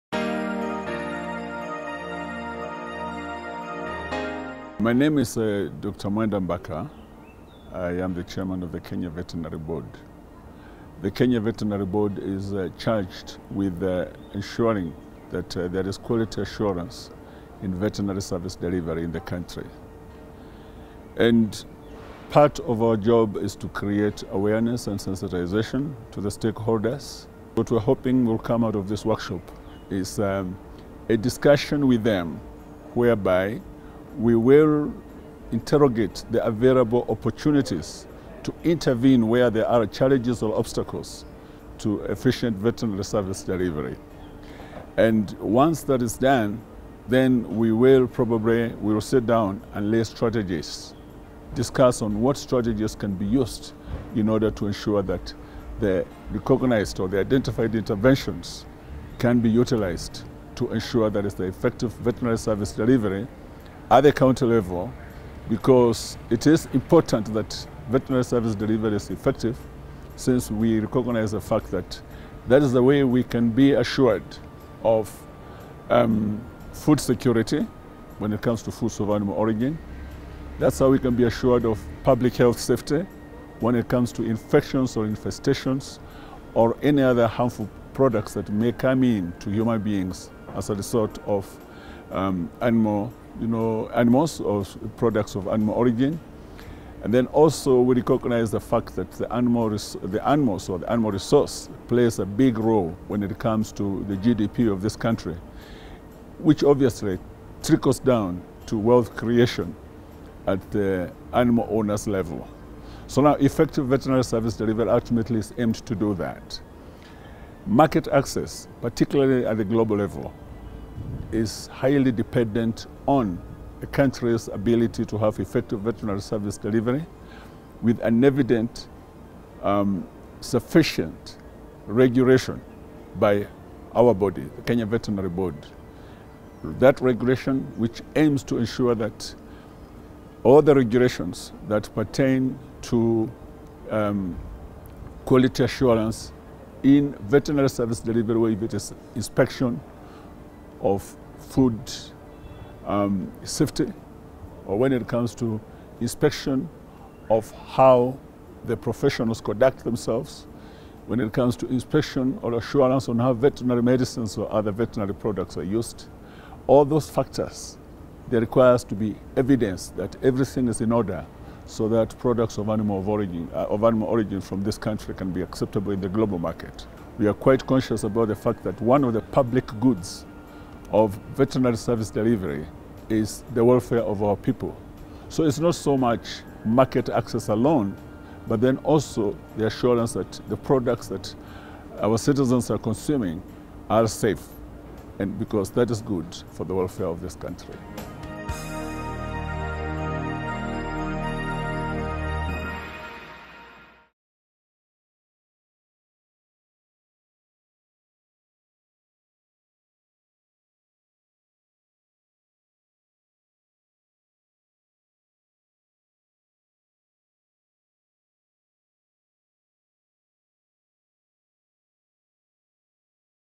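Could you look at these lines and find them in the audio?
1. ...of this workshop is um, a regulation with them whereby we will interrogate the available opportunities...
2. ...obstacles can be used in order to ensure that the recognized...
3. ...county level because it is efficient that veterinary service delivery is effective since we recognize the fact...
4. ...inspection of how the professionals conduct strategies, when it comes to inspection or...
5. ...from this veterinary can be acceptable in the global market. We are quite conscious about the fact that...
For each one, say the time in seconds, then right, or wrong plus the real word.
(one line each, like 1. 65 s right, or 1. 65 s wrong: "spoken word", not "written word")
1. 28 s wrong: "discussion", not "regulation"
2. 52 s wrong: "strategies", not "obstacles"
3. 64 s wrong: "important", not "efficient"
4. 155 s wrong: "themselves", not "strategies"
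5. 174 s wrong: "country", not "veterinary".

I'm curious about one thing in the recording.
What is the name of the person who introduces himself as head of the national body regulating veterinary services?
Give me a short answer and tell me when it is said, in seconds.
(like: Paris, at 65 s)
Dr. Mwenda Mbaka, at 5 s.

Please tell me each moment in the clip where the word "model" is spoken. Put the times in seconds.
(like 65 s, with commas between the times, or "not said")
not said.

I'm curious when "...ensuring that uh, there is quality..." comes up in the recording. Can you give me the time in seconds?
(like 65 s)
14 s.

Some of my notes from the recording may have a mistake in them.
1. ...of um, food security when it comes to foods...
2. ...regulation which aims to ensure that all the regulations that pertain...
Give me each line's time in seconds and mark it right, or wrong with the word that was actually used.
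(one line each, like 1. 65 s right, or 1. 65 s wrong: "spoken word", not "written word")
1. 74 s right
2. 137 s right.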